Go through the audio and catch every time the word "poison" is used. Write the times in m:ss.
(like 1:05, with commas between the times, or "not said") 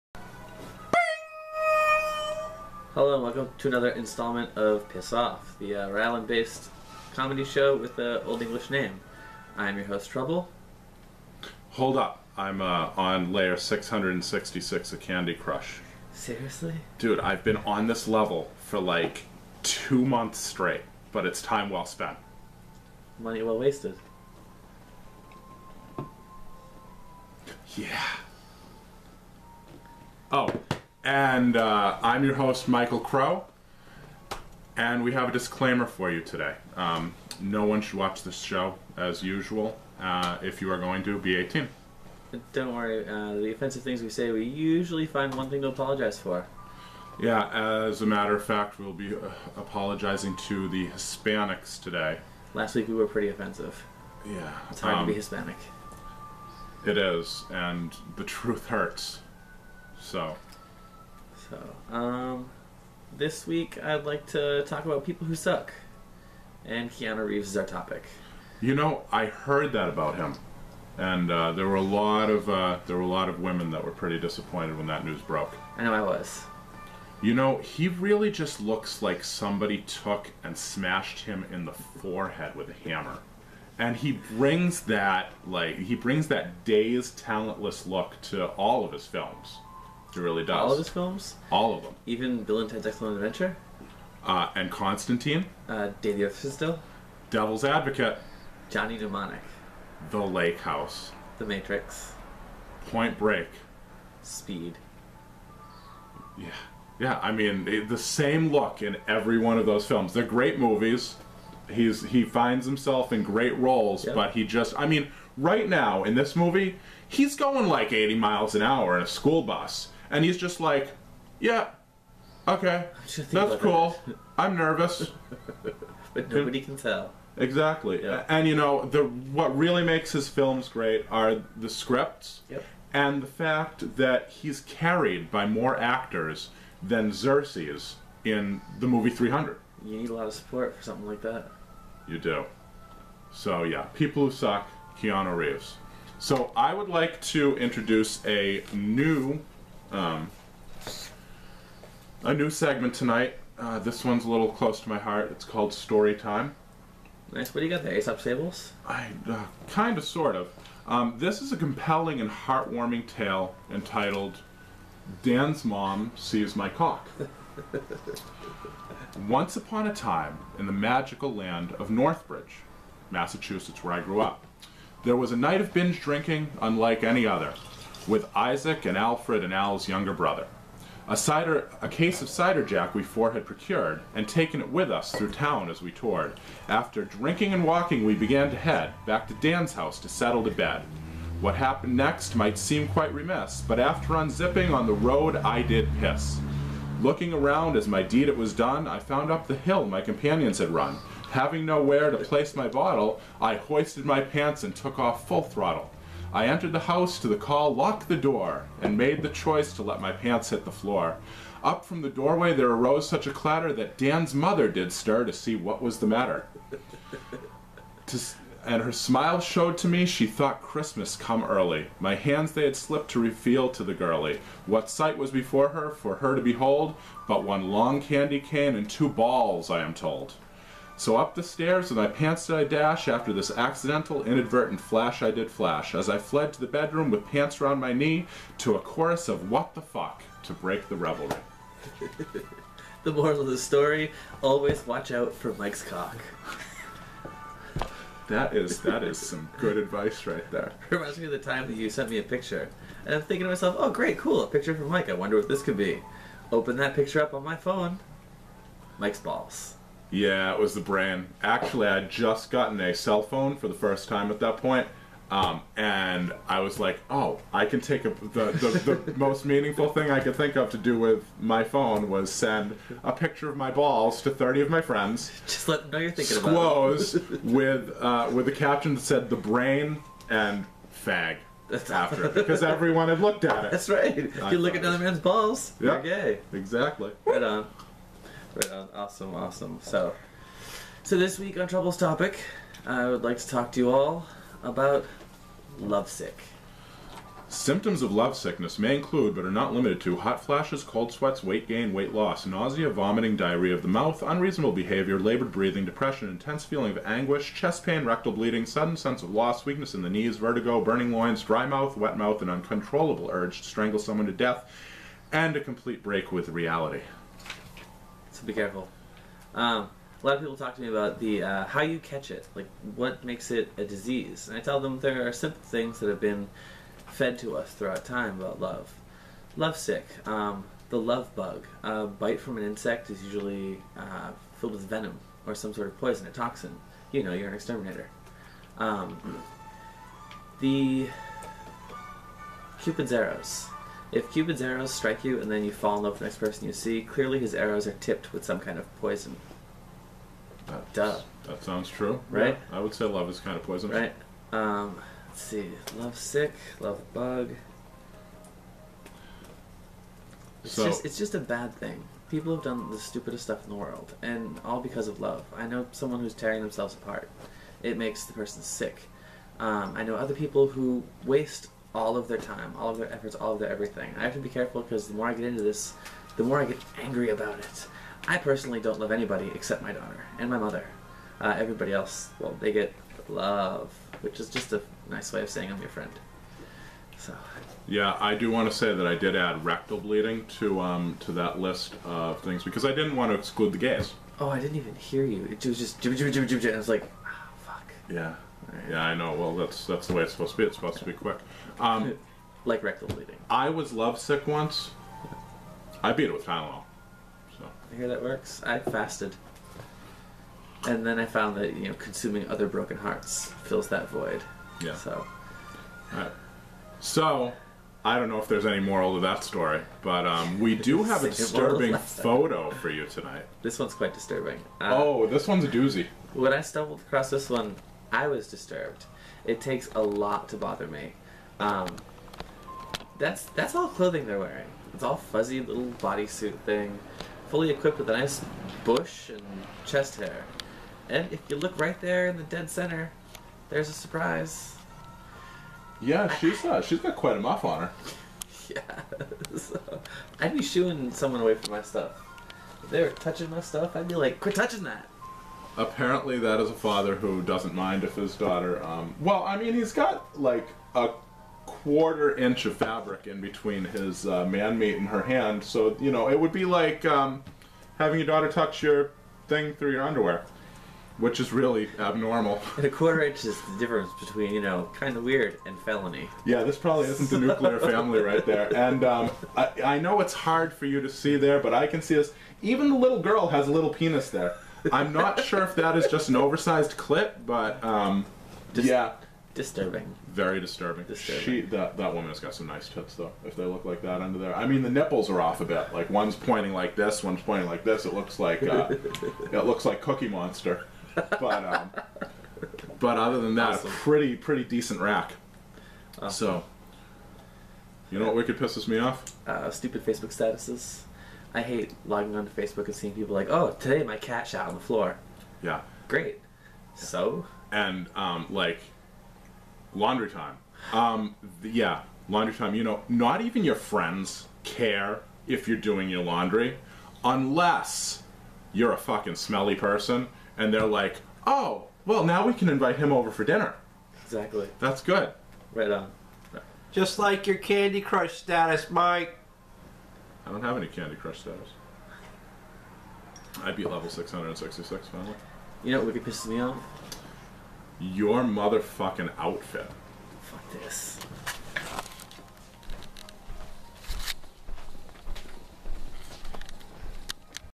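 5:35, 5:48, 5:53.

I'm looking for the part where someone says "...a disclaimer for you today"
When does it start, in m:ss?
0:35.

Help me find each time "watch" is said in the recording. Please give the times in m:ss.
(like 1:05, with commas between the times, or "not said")
0:37, 4:04.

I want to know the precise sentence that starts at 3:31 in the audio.
Up from the doorway there arose such a clatter that Dan's mother did stir to see what was the matter.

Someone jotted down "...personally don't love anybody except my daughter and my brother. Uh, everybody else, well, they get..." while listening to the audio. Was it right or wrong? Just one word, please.
wrong.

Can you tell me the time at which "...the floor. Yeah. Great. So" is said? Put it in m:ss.
8:34.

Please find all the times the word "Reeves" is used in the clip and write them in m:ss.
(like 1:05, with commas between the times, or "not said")
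1:07, 2:25.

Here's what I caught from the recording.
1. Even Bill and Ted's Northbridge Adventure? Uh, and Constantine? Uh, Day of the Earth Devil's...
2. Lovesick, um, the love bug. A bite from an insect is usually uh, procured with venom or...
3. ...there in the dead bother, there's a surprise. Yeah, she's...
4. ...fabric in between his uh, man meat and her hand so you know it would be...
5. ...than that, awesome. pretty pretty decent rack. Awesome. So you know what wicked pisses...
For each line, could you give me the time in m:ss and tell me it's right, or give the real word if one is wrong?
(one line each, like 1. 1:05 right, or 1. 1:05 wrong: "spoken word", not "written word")
1. 1:32 wrong: "Excellent", not "Northbridge"
2. 5:29 wrong: "filled", not "procured"
3. 7:22 wrong: "center", not "bother"
4. 7:42 right
5. 8:23 right.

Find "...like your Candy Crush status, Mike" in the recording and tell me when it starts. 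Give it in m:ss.
8:57.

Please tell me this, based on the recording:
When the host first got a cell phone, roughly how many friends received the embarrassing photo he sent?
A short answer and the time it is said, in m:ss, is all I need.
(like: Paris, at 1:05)
30, at 4:34.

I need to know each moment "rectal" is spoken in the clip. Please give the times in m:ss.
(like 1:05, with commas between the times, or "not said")
5:08, 6:29, 6:42.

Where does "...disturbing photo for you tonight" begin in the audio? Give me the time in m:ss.
7:01.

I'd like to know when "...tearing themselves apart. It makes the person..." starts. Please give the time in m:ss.
6:06.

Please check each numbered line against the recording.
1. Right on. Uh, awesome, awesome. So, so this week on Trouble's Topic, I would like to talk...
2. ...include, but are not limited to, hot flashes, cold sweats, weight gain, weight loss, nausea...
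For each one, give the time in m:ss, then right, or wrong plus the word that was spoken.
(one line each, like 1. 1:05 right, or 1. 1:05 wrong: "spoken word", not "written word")
1. 4:48 right
2. 4:58 right.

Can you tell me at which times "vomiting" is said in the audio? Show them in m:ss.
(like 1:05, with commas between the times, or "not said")
5:02.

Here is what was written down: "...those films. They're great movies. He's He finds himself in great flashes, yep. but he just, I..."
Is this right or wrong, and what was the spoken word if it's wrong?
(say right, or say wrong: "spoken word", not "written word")
wrong: "roles", not "flashes".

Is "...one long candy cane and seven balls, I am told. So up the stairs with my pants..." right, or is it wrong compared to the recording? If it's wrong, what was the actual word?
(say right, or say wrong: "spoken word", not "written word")
wrong: "two", not "seven".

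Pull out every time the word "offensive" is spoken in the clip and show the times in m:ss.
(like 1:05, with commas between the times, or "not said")
0:43, 0:53.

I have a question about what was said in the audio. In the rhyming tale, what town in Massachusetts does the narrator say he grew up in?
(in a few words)
Northbridge.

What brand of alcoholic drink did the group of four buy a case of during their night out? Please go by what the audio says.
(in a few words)
Cider Jack.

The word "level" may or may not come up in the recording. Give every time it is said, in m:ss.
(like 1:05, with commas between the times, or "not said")
0:18, 9:03.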